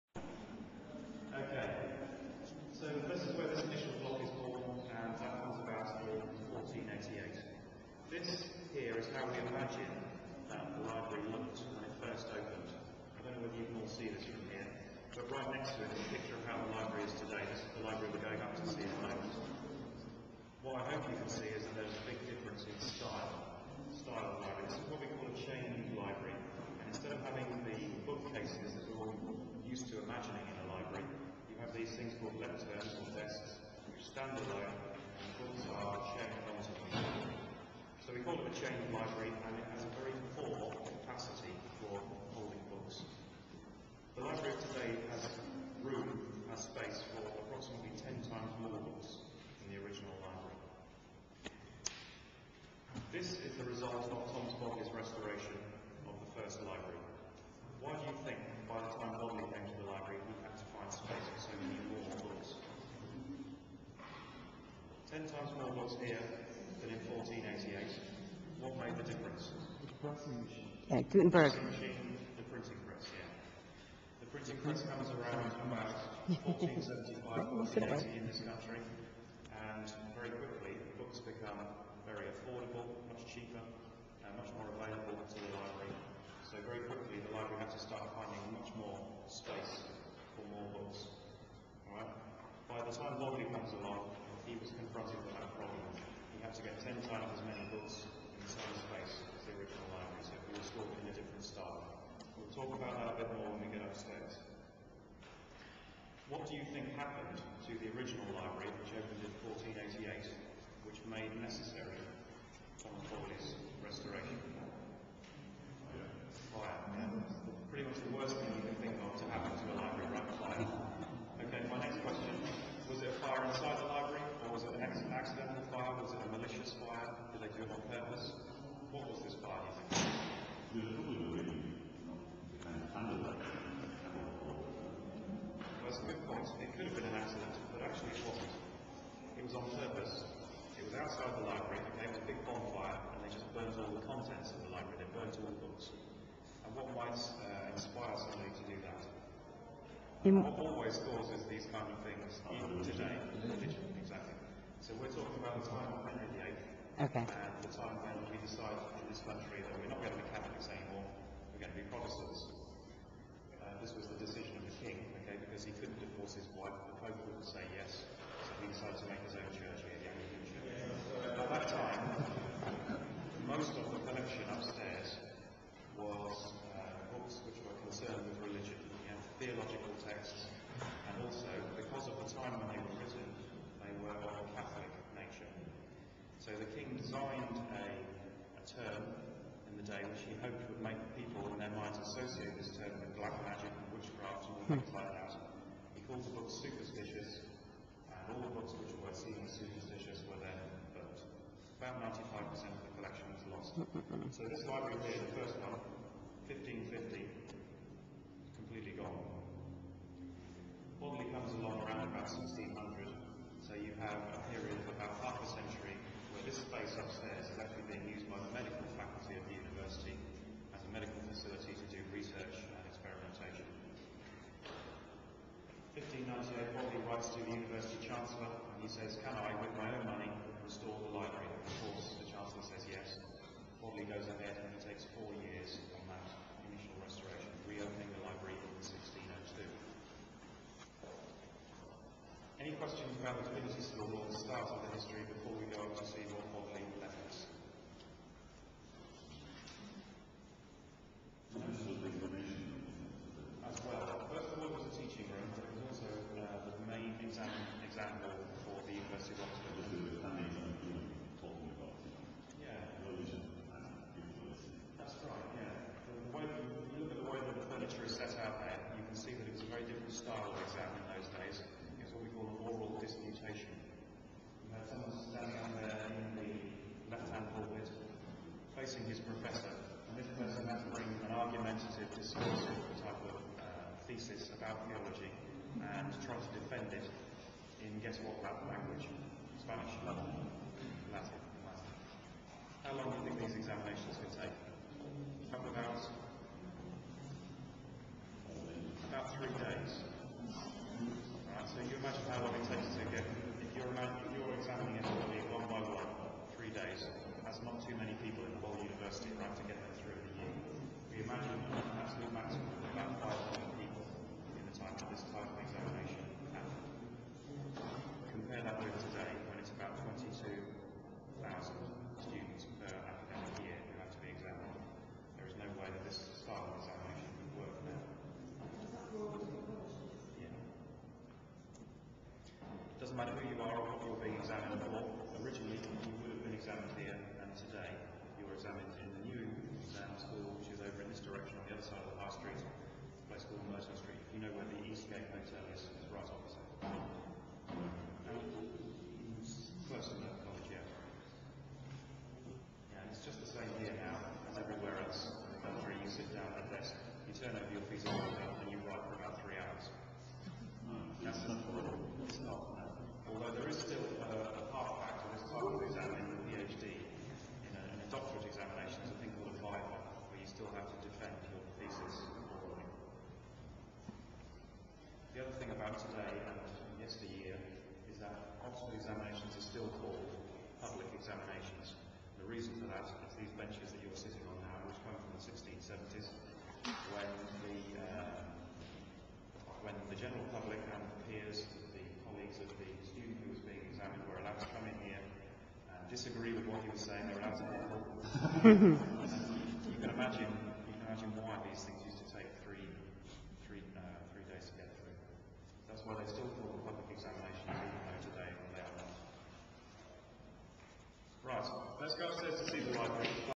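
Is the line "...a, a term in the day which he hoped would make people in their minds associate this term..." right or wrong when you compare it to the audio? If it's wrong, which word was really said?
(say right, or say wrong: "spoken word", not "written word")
right.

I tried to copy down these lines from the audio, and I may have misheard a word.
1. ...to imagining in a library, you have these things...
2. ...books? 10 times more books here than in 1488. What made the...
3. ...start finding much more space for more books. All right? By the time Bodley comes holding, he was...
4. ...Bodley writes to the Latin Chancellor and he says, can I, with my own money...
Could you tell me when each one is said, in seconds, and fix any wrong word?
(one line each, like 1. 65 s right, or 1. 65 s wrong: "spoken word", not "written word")
1. 29 s right
2. 62 s right
3. 87 s wrong: "along", not "holding"
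4. 226 s wrong: "University", not "Latin".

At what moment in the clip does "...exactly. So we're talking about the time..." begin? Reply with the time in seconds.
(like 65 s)
153 s.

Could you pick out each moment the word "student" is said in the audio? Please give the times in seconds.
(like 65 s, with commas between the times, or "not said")
393 s.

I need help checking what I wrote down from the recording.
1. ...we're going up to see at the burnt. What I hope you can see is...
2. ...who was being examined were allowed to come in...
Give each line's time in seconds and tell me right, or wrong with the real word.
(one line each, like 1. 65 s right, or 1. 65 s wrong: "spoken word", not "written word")
1. 18 s wrong: "moment", not "burnt"
2. 393 s right.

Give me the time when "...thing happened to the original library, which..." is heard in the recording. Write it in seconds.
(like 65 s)
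106 s.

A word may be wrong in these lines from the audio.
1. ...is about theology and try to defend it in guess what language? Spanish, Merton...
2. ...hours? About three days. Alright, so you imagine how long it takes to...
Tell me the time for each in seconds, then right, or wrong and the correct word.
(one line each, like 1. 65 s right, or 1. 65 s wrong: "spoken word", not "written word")
1. 284 s wrong: "Latin", not "Merton"
2. 295 s right.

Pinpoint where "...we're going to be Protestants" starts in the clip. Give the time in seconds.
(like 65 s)
161 s.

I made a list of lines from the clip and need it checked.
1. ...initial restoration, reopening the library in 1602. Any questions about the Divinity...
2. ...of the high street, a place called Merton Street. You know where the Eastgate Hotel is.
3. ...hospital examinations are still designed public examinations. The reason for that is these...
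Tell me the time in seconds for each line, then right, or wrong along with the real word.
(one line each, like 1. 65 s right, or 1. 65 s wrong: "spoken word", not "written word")
1. 236 s right
2. 342 s right
3. 378 s wrong: "called", not "designed".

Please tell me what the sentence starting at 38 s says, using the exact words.
So we call it a chain library, and it has a very poor capacity for holding books.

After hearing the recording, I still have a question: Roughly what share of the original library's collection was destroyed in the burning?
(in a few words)
95%.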